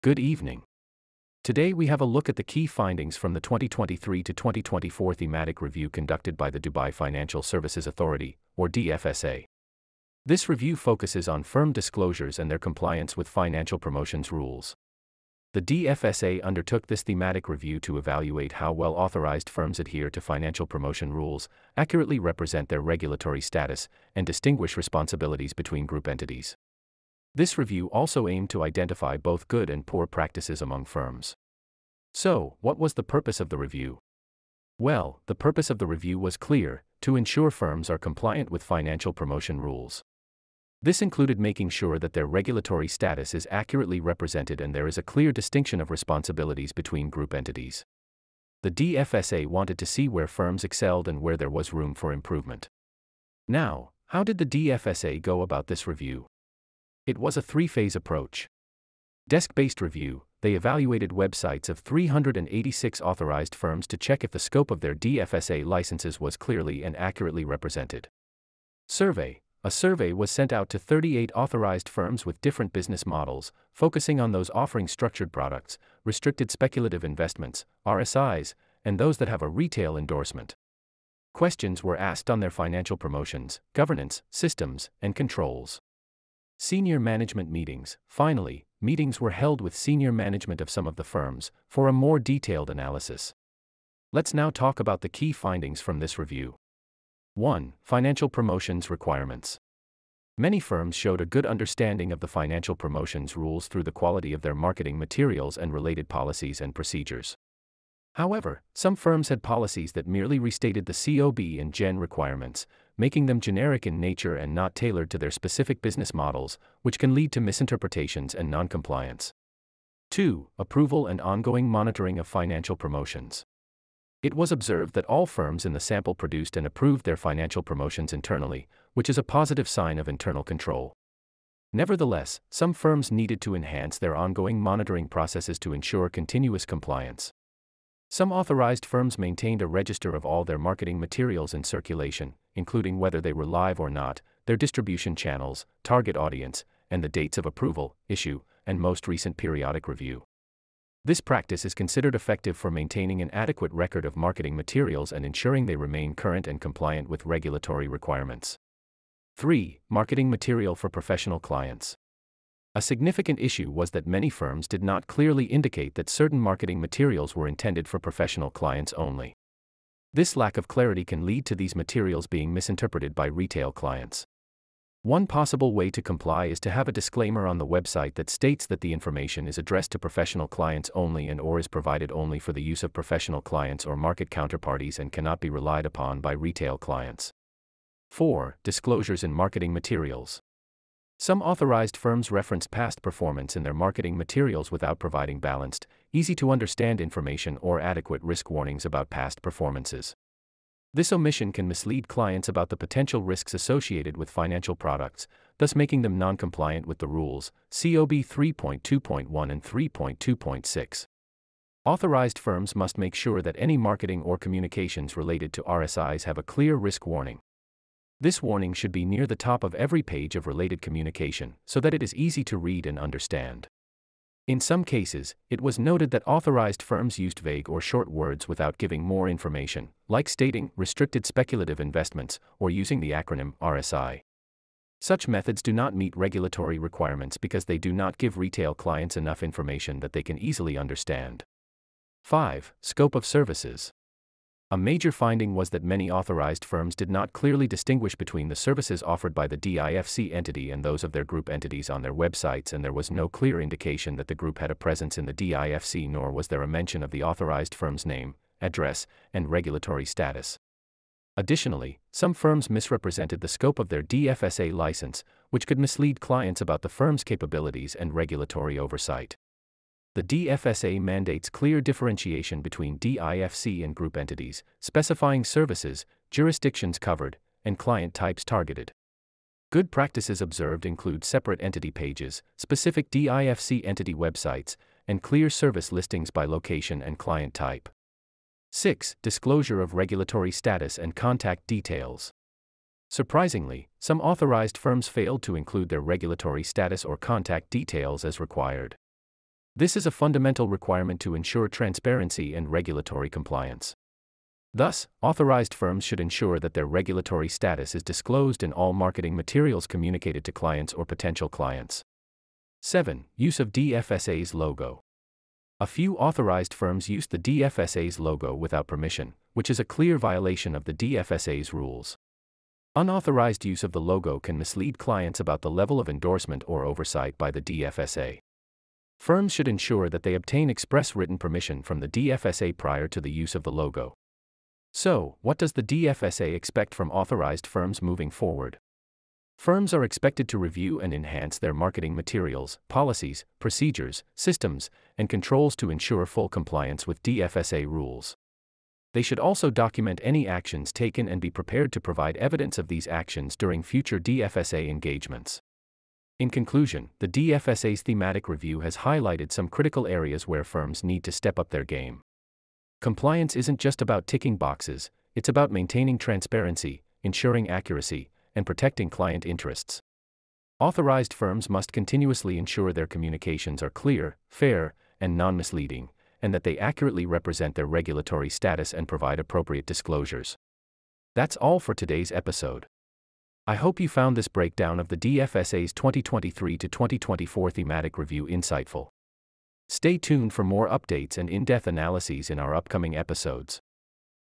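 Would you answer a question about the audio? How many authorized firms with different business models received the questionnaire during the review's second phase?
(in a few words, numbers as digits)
38.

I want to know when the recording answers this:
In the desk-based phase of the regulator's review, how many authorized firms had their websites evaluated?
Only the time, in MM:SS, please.
01:01.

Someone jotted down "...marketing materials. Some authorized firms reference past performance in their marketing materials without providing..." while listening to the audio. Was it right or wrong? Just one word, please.
right.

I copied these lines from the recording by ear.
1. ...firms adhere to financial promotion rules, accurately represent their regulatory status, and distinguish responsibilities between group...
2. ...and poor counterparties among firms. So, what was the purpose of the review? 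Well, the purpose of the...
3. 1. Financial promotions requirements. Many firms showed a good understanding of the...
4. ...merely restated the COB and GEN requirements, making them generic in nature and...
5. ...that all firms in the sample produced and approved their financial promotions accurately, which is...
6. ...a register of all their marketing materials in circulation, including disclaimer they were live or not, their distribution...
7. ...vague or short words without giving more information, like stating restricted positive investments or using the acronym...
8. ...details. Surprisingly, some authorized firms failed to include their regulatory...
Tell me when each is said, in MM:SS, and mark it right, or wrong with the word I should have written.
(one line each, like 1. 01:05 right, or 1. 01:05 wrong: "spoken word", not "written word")
1. 00:19 right
2. 00:29 wrong: "practices", not "counterparties"
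3. 01:37 right
4. 01:50 right
5. 02:04 wrong: "internally", not "accurately"
6. 02:19 wrong: "whether", not "disclaimer"
7. 03:47 wrong: "speculative", not "positive"
8. 04:51 right.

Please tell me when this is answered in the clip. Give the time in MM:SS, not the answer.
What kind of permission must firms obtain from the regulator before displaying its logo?
05:30.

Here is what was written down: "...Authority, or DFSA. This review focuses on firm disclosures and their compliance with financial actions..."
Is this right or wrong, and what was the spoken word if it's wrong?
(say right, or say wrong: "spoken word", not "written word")
wrong: "promotions", not "actions".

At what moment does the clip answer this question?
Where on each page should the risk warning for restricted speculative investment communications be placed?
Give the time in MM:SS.
03:39.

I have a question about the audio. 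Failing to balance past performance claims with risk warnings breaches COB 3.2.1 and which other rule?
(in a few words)
3.2.6.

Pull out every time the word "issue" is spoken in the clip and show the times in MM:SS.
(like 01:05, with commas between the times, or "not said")
02:28, 02:43.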